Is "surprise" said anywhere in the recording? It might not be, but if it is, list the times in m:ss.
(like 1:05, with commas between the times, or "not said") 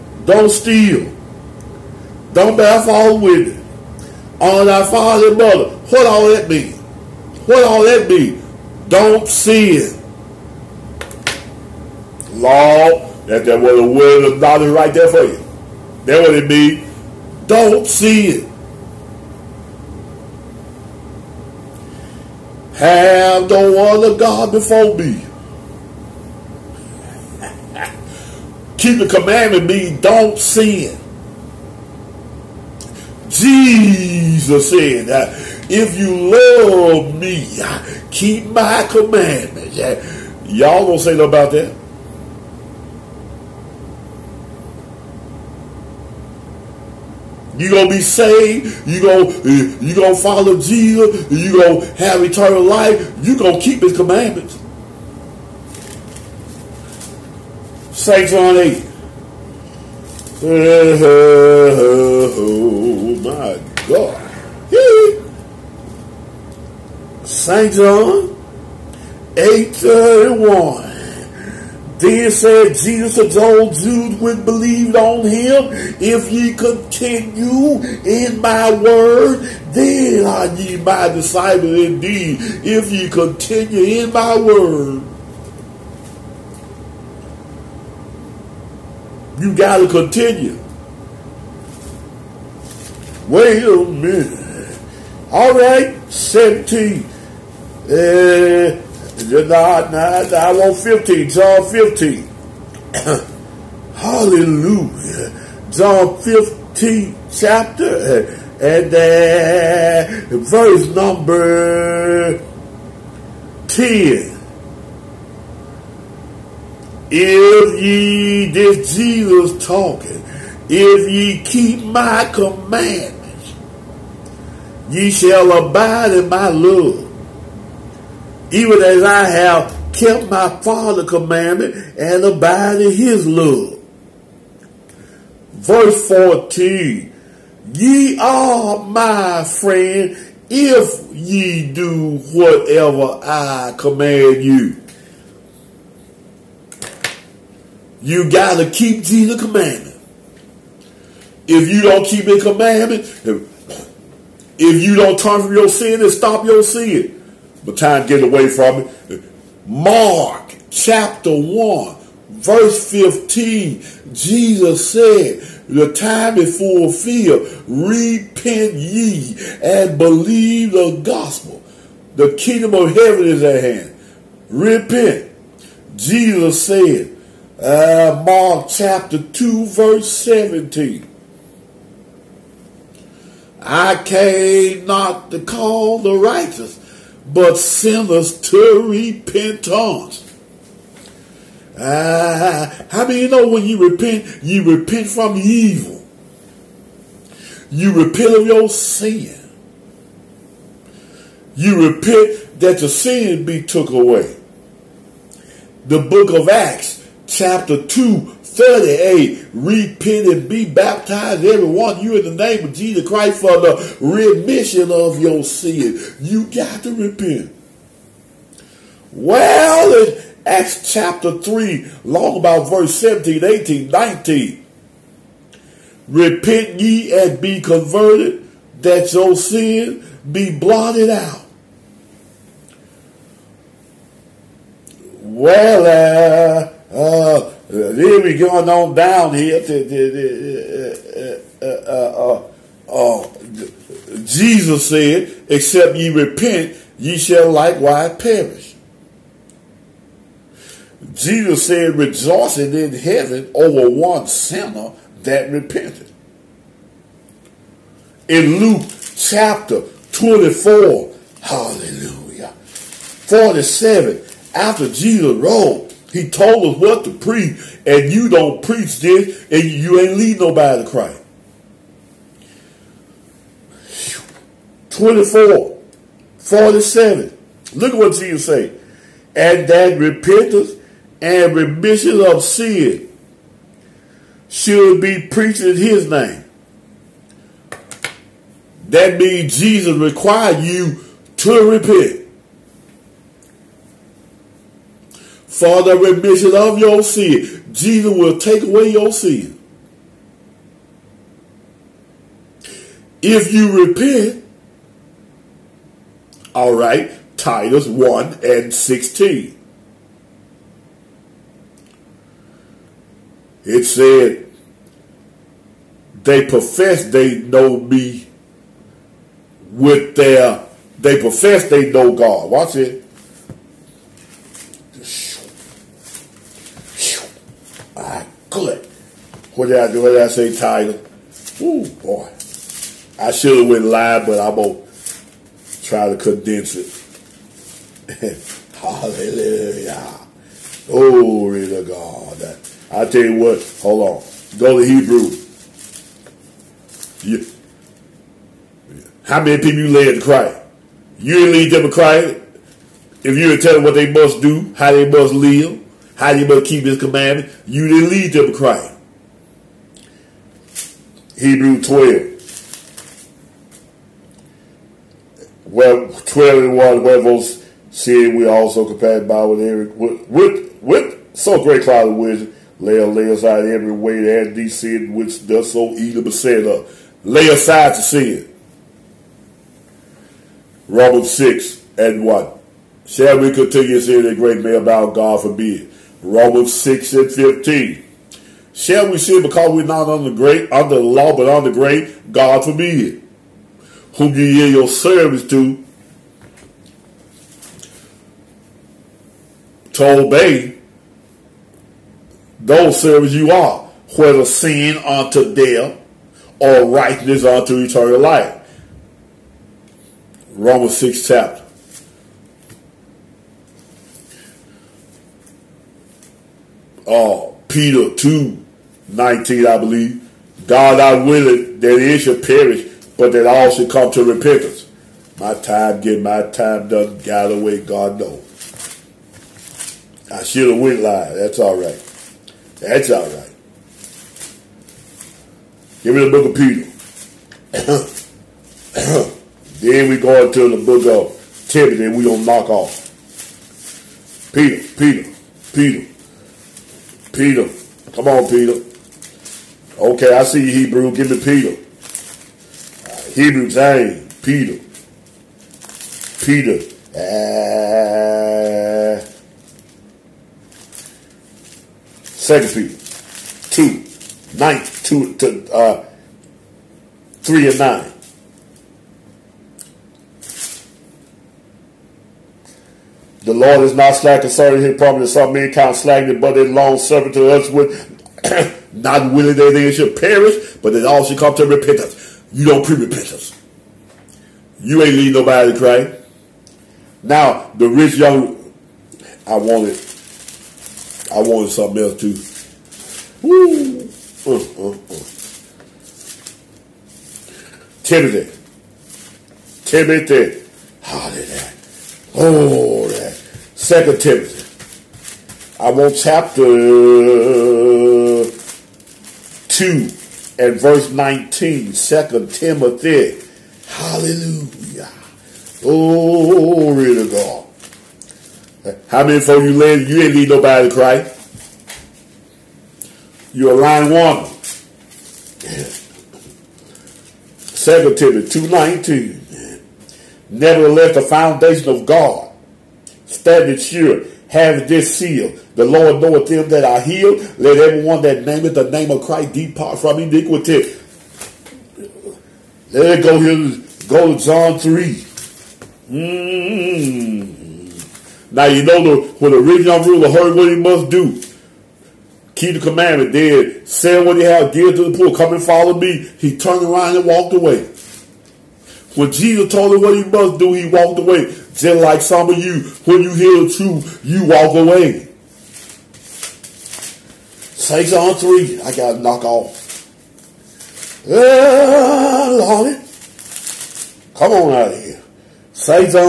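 not said.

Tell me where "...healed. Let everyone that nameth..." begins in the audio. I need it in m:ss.
8:57.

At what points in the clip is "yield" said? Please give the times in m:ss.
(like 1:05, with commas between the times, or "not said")
6:34.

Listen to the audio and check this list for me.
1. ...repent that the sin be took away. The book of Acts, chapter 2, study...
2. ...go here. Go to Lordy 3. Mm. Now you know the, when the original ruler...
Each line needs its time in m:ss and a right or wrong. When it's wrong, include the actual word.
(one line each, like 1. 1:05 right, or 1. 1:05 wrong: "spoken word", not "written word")
1. 3:21 right
2. 9:03 wrong: "John", not "Lordy".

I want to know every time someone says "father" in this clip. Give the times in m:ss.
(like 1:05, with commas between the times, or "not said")
0:04, 2:10.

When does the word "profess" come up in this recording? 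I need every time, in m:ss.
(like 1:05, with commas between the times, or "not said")
5:16, 5:21.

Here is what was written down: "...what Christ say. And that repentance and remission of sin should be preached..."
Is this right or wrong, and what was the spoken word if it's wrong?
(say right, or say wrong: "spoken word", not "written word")
wrong: "Jesus", not "Christ".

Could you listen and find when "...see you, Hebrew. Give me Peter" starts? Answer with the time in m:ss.
7:30.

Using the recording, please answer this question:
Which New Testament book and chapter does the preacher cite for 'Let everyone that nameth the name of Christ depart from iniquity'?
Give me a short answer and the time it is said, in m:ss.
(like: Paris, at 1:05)
Second Timothy 2, at 8:47.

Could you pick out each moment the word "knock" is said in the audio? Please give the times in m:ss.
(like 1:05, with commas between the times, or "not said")
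7:22, 9:29.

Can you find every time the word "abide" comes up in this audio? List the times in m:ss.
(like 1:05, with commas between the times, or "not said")
2:05, 2:12.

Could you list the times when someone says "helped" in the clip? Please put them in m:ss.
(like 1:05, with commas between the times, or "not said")
not said.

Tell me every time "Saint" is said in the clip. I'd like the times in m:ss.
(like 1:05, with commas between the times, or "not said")
0:57, 1:07.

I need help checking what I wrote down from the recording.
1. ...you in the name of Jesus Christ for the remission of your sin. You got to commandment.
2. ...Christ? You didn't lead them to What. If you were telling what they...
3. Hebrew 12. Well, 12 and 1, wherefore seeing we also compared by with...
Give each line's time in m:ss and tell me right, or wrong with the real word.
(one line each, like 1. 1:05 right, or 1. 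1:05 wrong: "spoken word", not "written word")
1. 3:32 wrong: "repent", not "commandment"
2. 5:50 wrong: "Christ", not "What"
3. 6:01 right.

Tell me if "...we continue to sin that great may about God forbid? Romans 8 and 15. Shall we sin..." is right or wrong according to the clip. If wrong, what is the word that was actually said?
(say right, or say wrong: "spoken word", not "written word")
wrong: "6", not "8".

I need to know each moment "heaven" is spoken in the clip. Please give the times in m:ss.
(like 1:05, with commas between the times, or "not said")
2:52, 4:12.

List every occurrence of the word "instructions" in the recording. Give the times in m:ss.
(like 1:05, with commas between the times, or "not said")
not said.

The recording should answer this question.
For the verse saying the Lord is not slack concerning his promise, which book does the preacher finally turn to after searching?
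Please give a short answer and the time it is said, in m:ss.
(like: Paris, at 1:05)
Second Peter, at 7:42.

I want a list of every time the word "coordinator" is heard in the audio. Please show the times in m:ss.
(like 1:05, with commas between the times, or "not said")
not said.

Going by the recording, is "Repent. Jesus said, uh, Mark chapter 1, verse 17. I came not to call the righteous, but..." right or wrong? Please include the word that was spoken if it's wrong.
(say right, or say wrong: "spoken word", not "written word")
wrong: "2", not "1".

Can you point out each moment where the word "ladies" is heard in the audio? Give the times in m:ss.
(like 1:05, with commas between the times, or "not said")
8:39.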